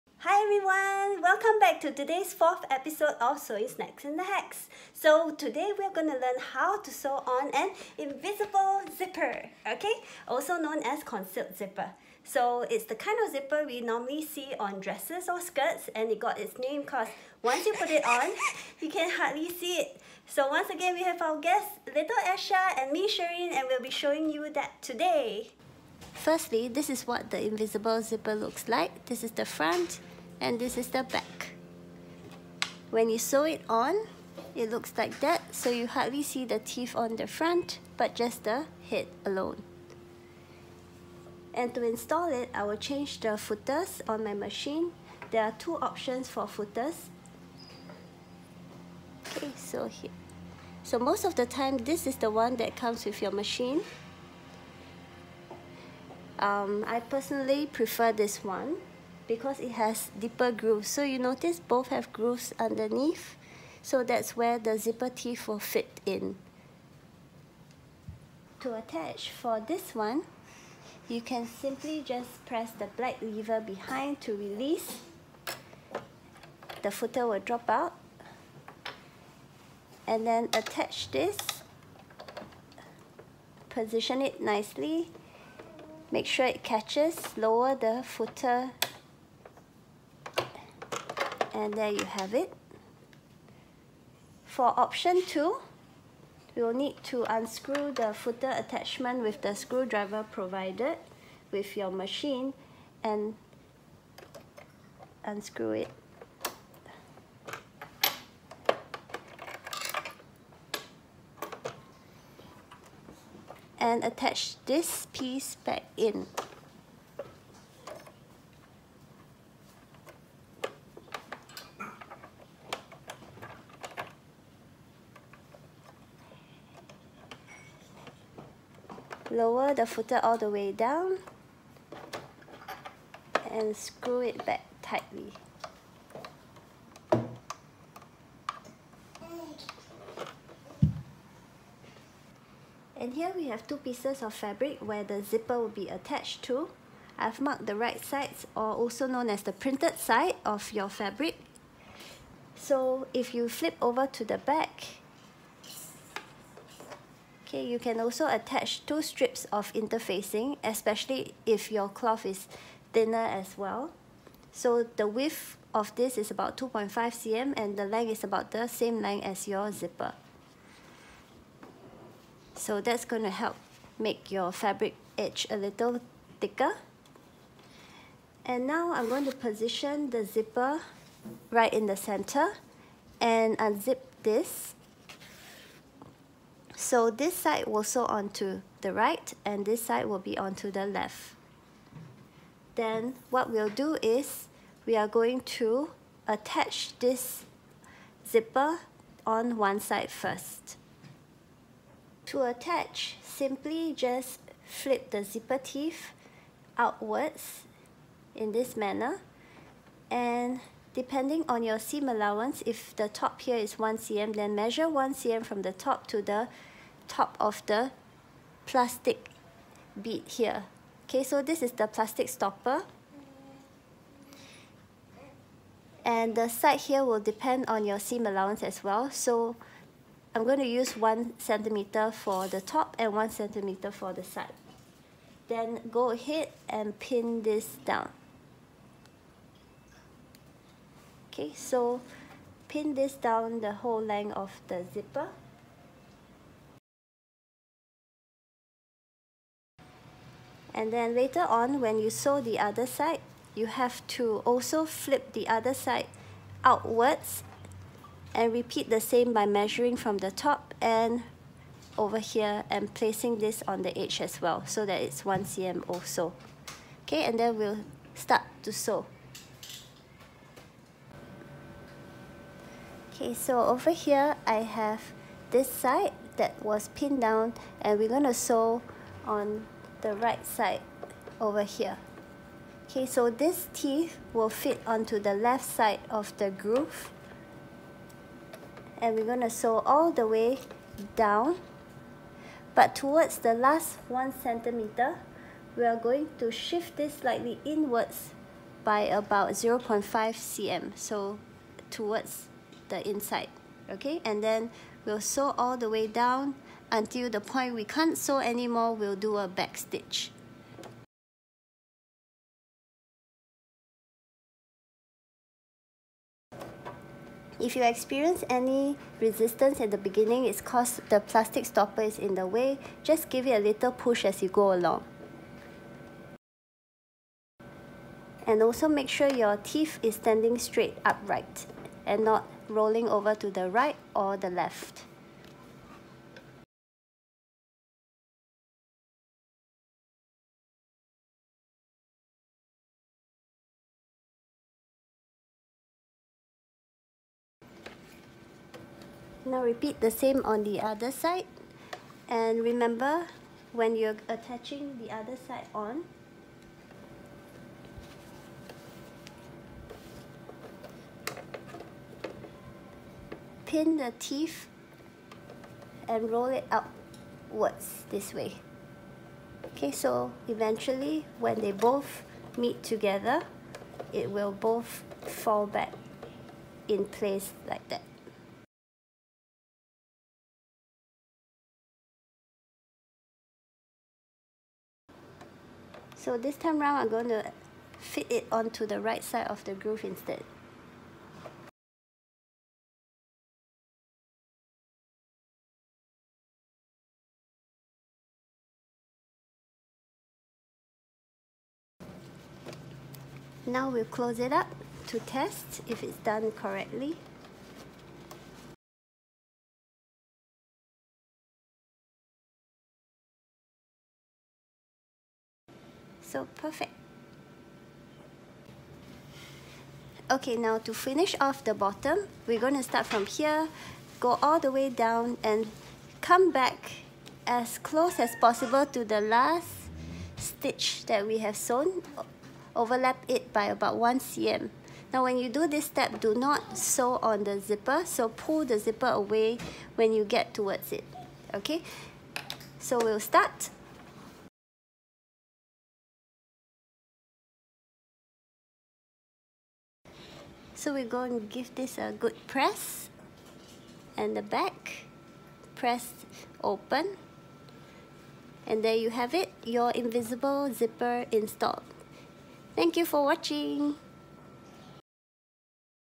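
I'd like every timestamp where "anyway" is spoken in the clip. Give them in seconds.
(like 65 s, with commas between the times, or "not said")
not said.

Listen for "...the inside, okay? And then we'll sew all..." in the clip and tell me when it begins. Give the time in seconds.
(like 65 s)
302 s.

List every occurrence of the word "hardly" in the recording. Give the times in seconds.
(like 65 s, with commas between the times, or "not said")
19 s, 35 s.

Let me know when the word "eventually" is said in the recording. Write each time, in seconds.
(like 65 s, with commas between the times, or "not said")
370 s.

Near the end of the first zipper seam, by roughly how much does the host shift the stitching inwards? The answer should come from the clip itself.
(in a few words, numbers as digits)
0.5 cm.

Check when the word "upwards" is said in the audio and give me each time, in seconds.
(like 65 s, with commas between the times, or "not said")
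366 s.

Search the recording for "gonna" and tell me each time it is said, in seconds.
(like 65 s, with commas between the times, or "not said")
5 s, 278 s, 289 s.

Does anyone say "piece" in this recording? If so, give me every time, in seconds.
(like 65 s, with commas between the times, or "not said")
115 s, 143 s.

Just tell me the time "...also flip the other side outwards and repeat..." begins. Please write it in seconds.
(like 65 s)
254 s.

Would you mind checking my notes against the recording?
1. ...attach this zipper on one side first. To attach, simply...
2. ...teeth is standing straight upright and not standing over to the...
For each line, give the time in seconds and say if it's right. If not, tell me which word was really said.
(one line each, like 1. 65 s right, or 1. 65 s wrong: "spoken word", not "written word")
1. 196 s right
2. 329 s wrong: "rolling", not "standing".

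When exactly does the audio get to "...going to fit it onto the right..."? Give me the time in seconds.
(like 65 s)
387 s.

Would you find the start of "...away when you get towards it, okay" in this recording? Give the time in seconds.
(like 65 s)
439 s.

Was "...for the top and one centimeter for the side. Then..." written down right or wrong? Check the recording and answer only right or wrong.
right.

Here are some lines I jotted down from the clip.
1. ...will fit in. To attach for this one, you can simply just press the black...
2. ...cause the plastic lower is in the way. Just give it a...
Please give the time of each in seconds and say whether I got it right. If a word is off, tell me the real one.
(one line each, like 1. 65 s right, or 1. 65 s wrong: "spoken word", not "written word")
1. 65 s right
2. 320 s wrong: "stopper", not "lower".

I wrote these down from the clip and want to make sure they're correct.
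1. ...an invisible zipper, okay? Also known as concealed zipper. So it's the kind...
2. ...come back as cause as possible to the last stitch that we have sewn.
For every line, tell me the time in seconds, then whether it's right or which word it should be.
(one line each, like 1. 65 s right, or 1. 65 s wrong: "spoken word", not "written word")
1. 7 s right
2. 426 s wrong: "close", not "cause".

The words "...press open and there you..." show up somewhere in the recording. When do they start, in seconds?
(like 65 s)
455 s.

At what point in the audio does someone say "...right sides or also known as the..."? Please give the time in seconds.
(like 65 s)
147 s.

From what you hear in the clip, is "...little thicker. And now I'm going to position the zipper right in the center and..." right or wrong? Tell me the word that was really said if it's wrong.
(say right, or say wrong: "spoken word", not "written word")
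right.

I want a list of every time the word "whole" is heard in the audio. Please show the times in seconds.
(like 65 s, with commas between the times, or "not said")
243 s.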